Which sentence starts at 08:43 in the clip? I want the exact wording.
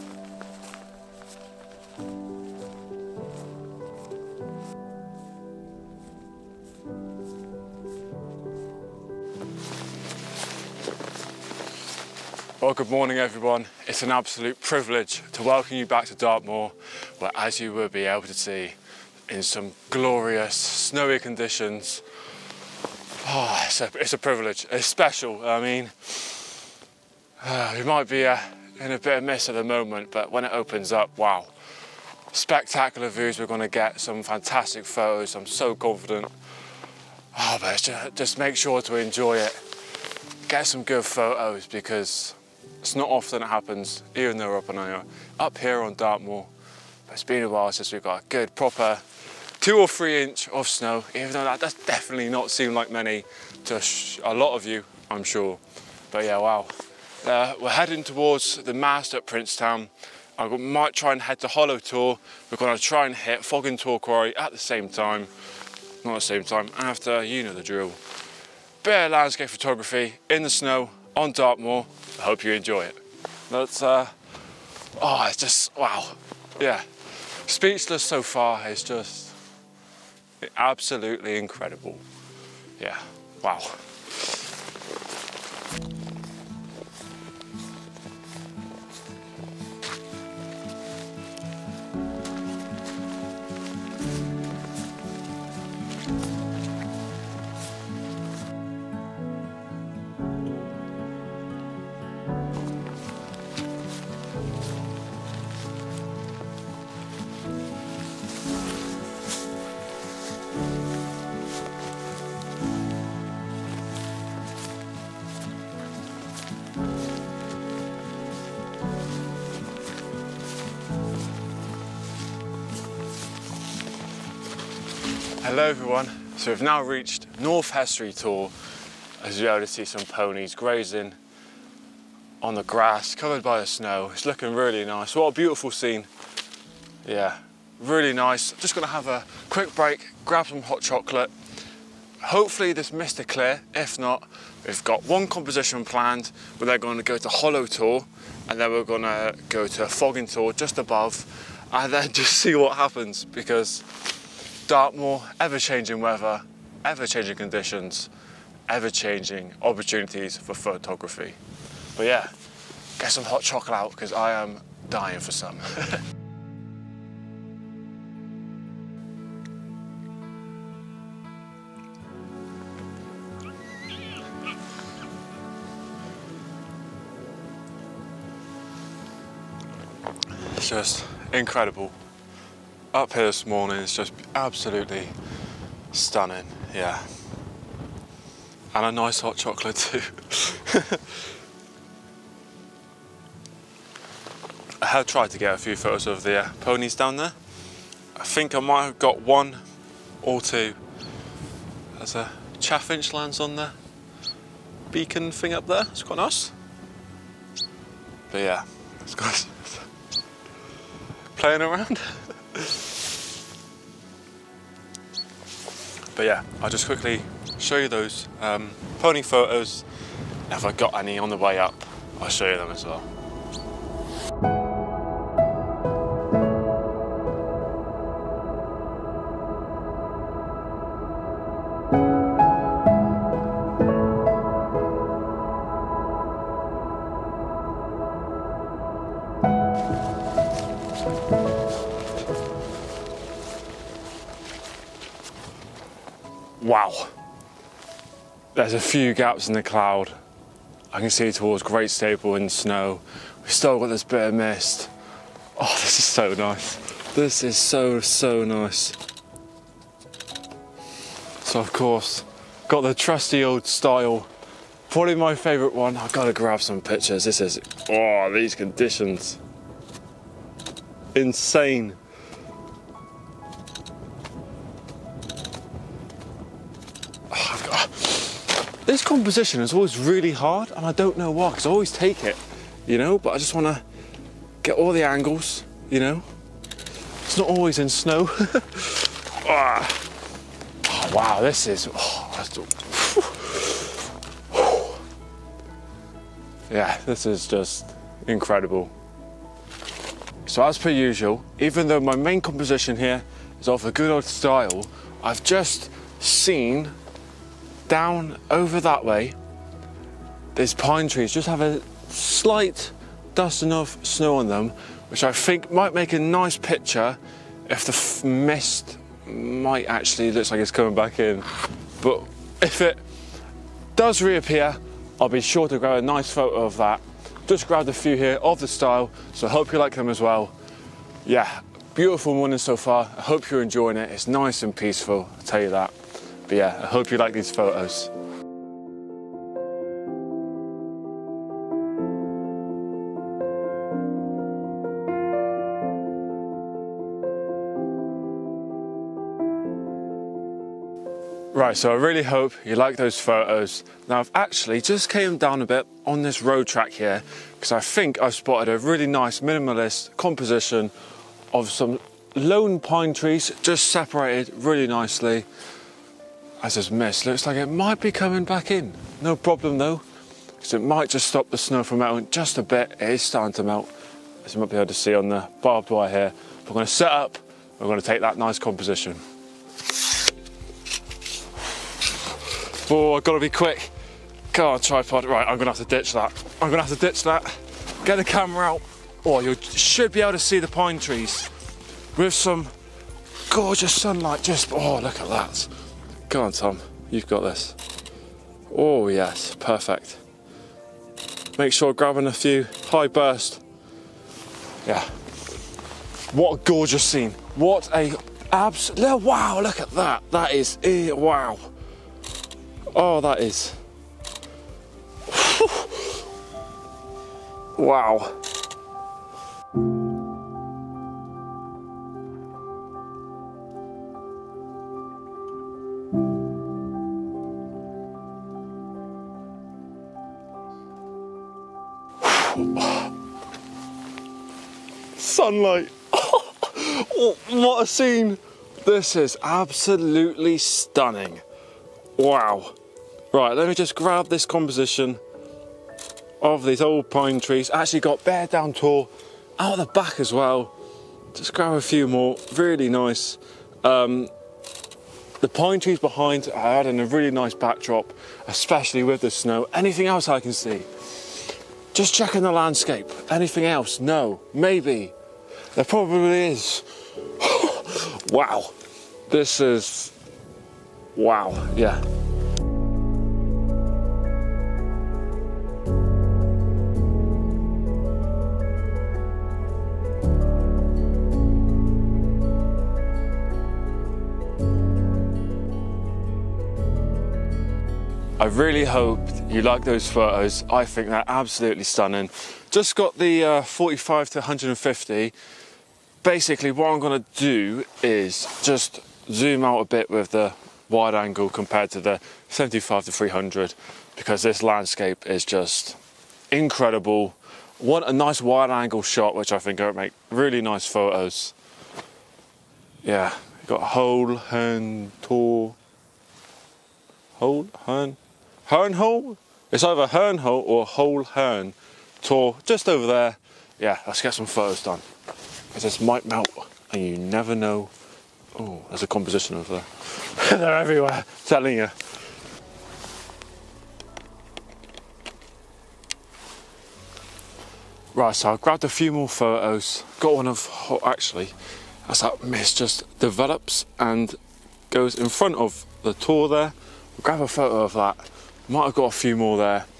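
Yeah, let's get some photos done.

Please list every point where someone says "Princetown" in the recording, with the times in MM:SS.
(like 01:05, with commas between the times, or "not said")
00:59.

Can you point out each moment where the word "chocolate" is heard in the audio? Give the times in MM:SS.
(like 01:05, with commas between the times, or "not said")
02:20, 02:43, 03:09.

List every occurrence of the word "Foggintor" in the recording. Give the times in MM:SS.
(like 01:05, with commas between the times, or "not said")
01:03, 02:29.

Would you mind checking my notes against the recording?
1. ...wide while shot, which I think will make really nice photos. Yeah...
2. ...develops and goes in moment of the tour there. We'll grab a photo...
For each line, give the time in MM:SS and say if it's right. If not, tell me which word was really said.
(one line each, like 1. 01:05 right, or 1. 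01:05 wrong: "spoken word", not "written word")
1. 08:28 wrong: "angle", not "while"
2. 09:03 wrong: "front", not "moment".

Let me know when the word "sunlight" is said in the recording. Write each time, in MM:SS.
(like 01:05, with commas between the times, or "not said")
06:33, 07:15.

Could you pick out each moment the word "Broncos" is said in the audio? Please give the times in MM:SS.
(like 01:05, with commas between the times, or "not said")
not said.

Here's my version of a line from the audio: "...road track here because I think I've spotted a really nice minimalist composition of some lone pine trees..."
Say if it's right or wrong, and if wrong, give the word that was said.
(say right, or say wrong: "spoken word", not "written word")
right.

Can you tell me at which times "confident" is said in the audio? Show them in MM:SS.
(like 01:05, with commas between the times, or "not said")
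00:35.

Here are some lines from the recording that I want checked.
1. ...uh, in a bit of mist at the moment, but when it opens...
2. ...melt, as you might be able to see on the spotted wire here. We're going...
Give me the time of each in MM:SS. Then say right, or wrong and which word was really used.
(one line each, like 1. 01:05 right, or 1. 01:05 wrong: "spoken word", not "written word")
1. 00:28 right
2. 06:13 wrong: "barbed", not "spotted".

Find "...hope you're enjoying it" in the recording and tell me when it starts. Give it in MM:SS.
05:33.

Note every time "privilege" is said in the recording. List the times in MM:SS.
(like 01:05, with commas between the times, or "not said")
00:14, 00:24.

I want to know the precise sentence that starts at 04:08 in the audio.
There's a few gaps in the cloud.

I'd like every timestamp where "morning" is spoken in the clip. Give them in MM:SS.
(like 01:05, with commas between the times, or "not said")
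00:12, 03:03, 05:32.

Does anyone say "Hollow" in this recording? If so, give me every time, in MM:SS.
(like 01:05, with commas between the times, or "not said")
01:01, 02:27.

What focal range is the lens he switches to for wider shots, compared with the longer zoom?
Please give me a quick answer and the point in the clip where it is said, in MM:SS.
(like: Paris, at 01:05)
45 to 150, at 08:13.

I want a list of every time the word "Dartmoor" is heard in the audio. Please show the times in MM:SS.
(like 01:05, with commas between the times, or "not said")
00:16, 00:45, 01:11, 02:34.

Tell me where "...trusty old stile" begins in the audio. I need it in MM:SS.
04:22.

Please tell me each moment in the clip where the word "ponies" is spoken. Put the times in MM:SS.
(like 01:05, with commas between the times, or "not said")
02:10, 03:16.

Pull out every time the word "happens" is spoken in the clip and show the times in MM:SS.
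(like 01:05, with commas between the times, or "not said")
00:43, 02:32.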